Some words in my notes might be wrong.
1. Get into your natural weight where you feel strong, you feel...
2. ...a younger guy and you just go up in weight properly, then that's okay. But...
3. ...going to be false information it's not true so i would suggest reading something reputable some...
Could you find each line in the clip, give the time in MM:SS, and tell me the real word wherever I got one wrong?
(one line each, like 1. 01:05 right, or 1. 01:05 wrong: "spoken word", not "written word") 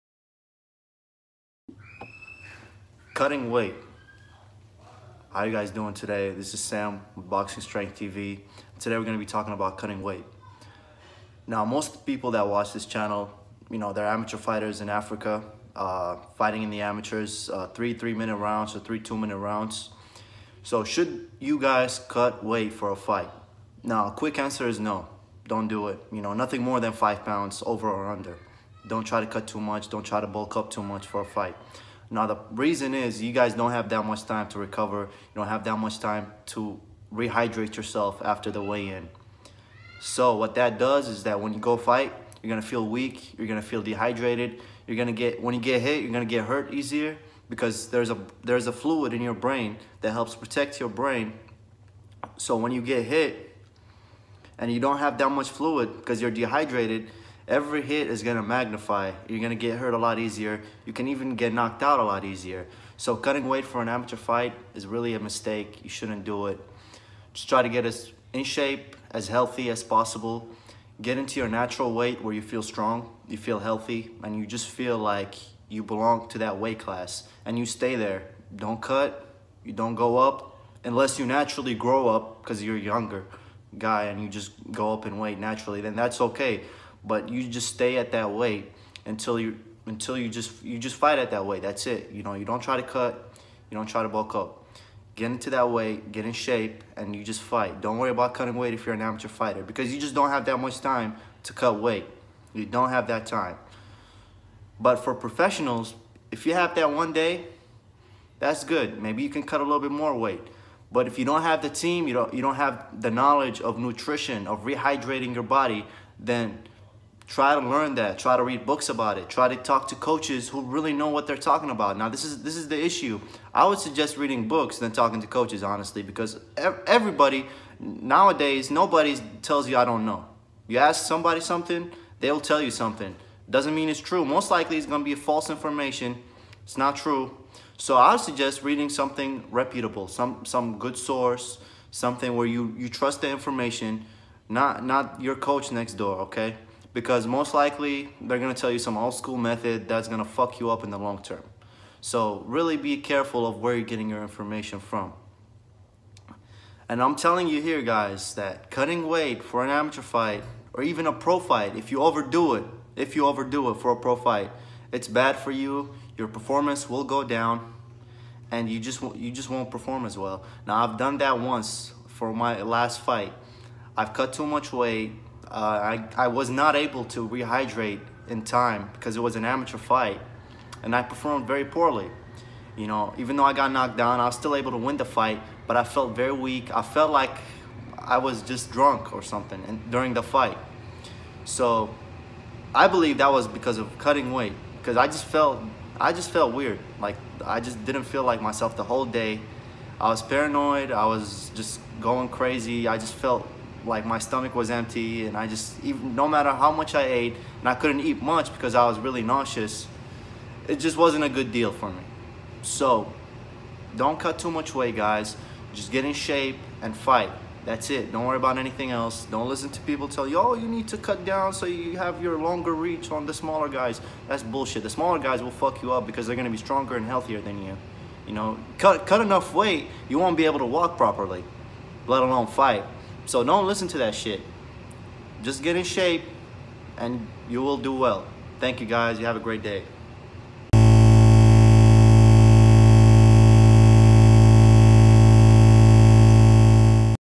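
1. 01:11 right
2. 01:22 wrong: "naturally", not "properly"
3. 02:14 right.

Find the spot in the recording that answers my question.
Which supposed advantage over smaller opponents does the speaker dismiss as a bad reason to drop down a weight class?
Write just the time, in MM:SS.
03:42.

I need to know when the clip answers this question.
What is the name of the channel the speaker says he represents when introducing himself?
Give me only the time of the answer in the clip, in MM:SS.
00:07.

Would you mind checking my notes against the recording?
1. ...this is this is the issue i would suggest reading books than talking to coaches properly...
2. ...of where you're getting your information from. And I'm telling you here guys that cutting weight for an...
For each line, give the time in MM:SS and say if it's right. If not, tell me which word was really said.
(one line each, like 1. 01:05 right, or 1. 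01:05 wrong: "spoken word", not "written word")
1. 02:02 wrong: "honestly", not "properly"
2. 02:33 right.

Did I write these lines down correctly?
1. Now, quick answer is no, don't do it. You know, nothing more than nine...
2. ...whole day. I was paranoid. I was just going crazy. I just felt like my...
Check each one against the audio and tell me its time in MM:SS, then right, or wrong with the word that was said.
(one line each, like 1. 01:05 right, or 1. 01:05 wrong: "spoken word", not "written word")
1. 00:23 wrong: "five", not "nine"
2. 03:18 right.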